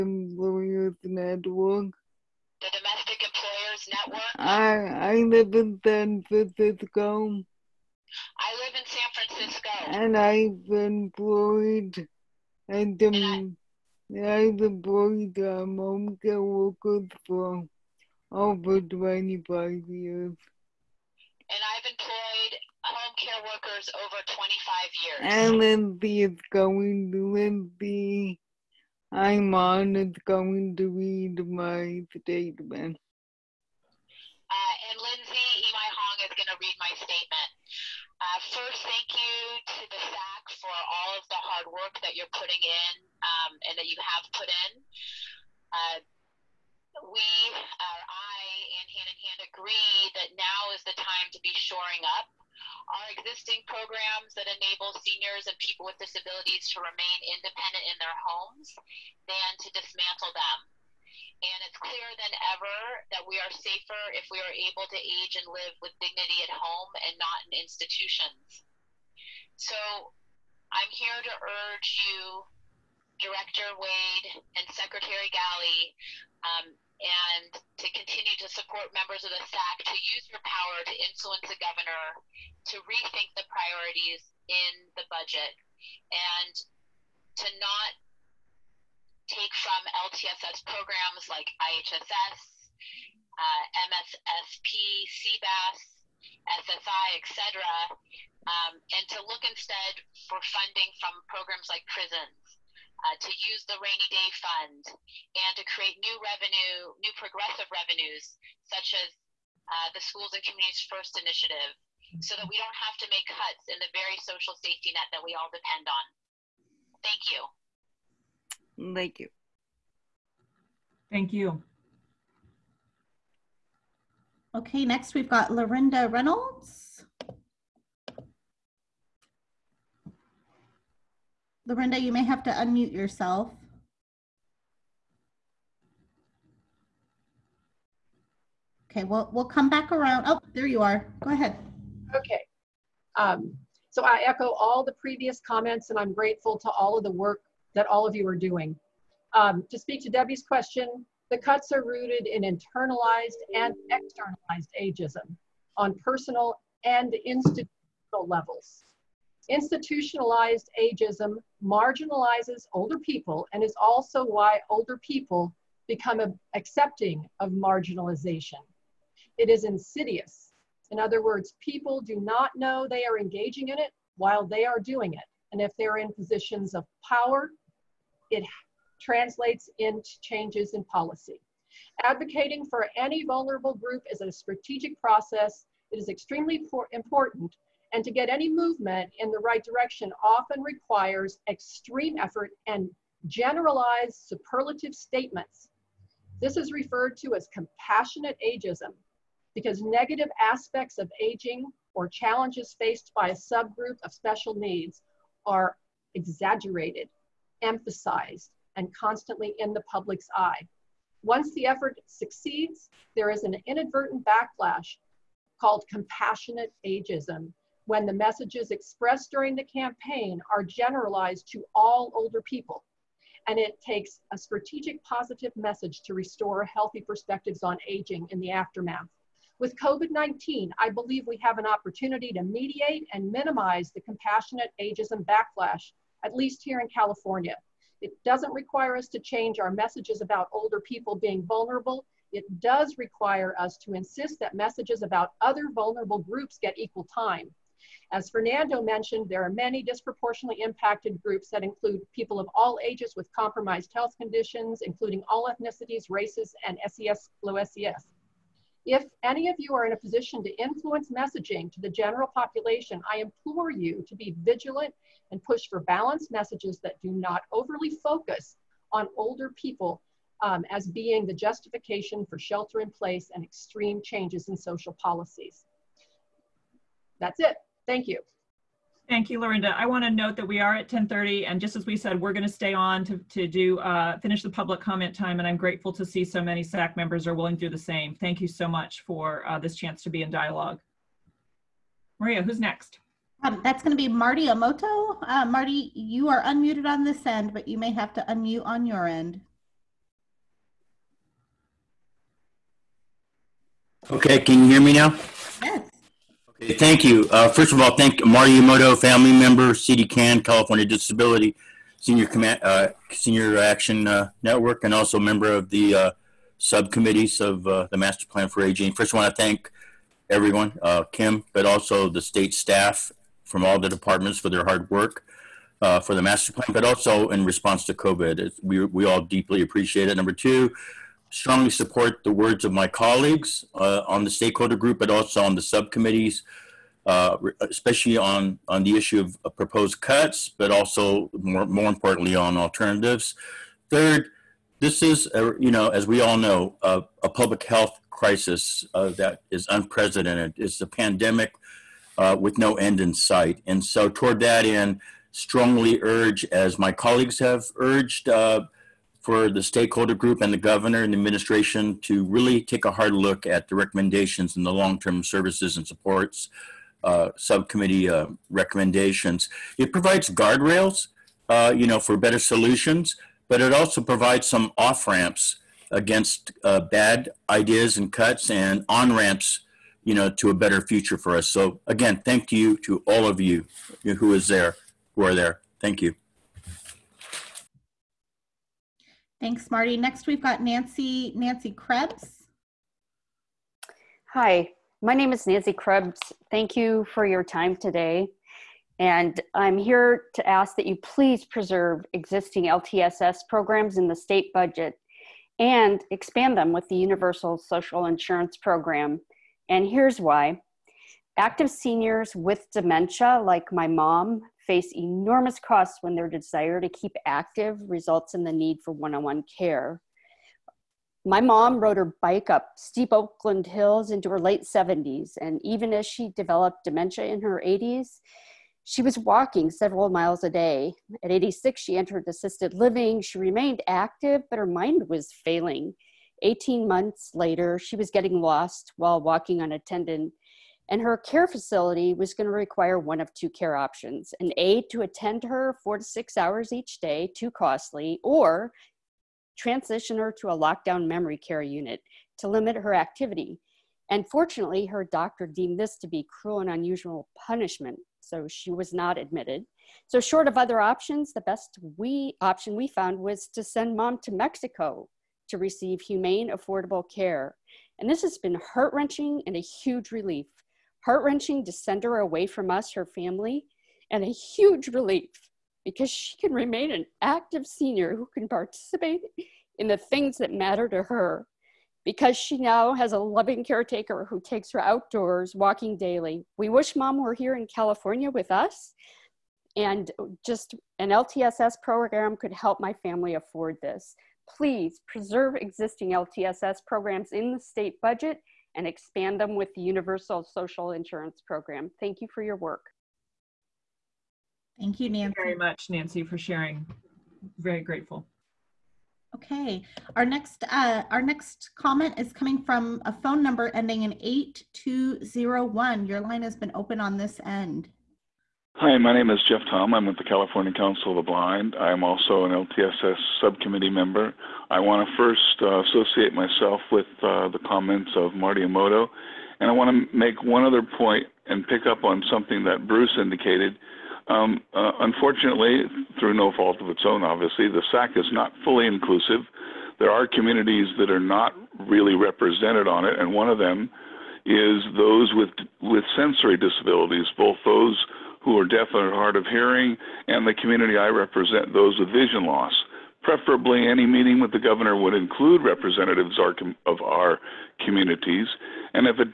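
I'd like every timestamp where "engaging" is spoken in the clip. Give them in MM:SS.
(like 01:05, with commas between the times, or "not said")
02:53.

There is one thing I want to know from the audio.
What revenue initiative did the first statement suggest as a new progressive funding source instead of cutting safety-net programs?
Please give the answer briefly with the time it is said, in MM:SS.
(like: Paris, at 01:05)
Schools and Communities First Initiative, at 01:50.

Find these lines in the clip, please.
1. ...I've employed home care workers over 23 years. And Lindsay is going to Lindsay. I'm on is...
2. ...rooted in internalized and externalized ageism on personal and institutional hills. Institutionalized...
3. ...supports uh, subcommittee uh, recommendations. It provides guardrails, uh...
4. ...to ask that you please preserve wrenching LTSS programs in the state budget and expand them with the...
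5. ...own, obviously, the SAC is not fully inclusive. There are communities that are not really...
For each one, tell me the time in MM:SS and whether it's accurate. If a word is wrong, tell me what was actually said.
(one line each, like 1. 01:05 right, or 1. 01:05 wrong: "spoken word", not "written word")
1. 00:21 wrong: "25", not "23"
2. 02:31 wrong: "levels", not "hills"
3. 06:05 right
4. 06:40 wrong: "existing", not "wrenching"
5. 08:57 right.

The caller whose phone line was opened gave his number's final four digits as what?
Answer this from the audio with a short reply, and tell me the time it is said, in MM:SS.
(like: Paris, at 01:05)
8201, at 08:34.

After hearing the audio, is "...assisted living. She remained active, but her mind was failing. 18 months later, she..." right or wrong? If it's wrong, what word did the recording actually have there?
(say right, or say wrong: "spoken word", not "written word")
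right.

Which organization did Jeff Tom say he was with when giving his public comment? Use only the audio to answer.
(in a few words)
California Council of the Blind.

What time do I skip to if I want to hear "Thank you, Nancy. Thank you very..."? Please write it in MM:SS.
08:24.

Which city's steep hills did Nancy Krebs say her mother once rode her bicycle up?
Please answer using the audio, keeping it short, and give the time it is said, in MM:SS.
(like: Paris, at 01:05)
Oakland, at 07:03.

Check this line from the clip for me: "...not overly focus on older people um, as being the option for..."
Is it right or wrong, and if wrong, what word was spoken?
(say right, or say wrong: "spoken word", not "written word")
wrong: "justification", not "option".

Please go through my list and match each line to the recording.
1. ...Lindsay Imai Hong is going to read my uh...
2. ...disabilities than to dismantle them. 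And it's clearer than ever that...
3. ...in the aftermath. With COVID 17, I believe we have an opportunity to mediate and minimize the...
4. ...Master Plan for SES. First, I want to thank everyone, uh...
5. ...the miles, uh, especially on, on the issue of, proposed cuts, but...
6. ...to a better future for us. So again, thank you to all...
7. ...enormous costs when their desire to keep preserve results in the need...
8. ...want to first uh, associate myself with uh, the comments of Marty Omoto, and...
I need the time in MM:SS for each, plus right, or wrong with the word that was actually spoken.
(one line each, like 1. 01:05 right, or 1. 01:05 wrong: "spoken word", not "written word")
1. 00:35 right
2. 00:58 wrong: "homes", not "disabilities"
3. 03:48 wrong: "19", not "17"
4. 05:17 wrong: "Aging", not "SES"
5. 05:35 wrong: "subcommittees", not "miles"
6. 06:20 right
7. 06:54 wrong: "active", not "preserve"
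8. 08:44 right.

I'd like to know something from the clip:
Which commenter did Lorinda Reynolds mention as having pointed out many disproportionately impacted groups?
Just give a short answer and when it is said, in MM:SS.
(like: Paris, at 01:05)
Fernando, at 04:08.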